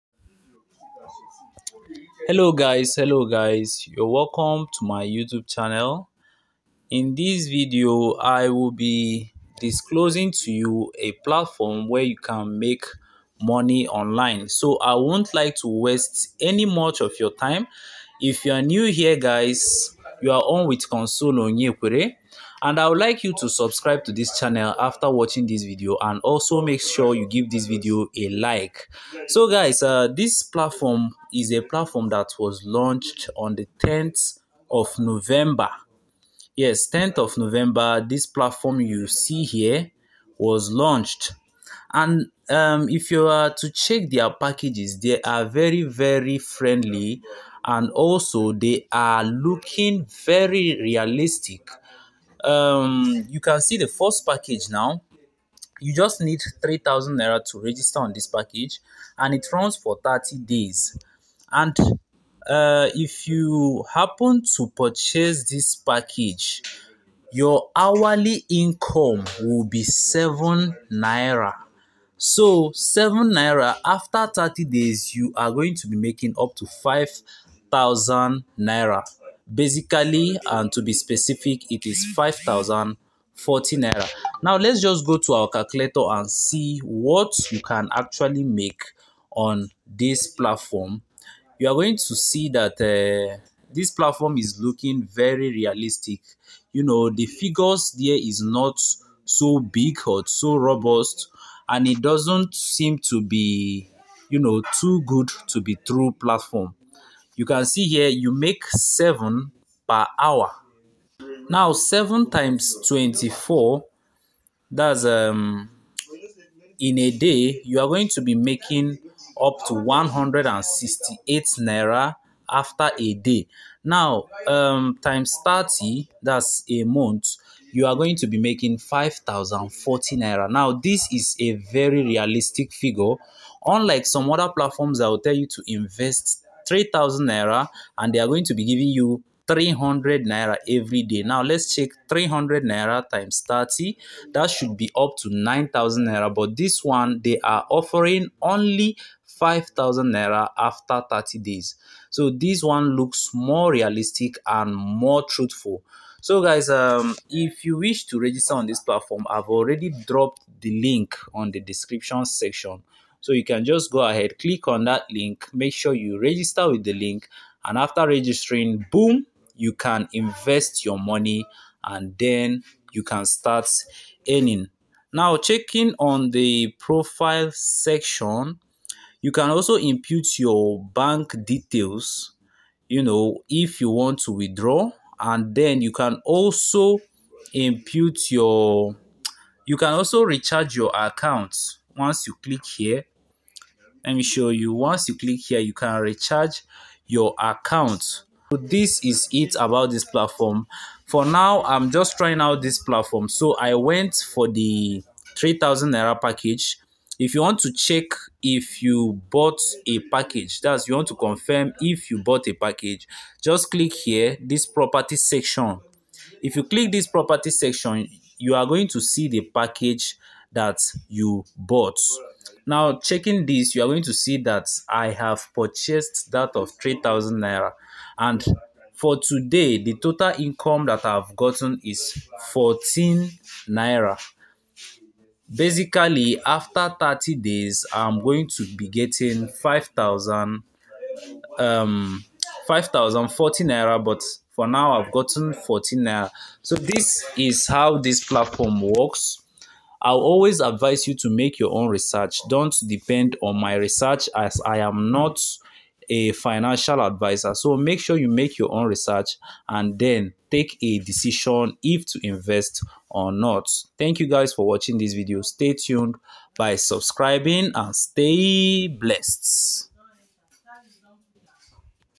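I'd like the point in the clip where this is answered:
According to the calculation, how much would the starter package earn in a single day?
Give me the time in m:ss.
1:59.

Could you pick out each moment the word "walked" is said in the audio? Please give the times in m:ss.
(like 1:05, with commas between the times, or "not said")
not said.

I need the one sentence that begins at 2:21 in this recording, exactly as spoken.
Now let's check 300 naira times 30.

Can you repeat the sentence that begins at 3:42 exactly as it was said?
Now, checking this, you are going to see that I have purchased that of 3,000 Naira.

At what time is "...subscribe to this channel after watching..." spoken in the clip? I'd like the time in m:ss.
0:23.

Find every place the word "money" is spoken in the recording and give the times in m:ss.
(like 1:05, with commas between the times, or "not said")
0:13, 2:50.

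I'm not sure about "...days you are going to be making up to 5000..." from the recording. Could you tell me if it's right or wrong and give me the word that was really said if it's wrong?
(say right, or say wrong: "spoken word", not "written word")
right.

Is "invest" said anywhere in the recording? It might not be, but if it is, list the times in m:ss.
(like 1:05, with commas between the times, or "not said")
2:15, 2:50, 4:22.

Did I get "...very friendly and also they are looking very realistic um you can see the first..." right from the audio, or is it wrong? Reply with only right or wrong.
right.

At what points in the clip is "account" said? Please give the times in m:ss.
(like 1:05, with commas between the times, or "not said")
3:10, 3:17.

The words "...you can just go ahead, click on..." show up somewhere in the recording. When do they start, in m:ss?
2:43.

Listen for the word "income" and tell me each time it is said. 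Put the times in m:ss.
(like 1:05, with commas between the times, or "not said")
1:08, 3:50.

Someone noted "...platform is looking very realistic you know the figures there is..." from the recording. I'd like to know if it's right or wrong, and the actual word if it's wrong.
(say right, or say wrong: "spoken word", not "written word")
right.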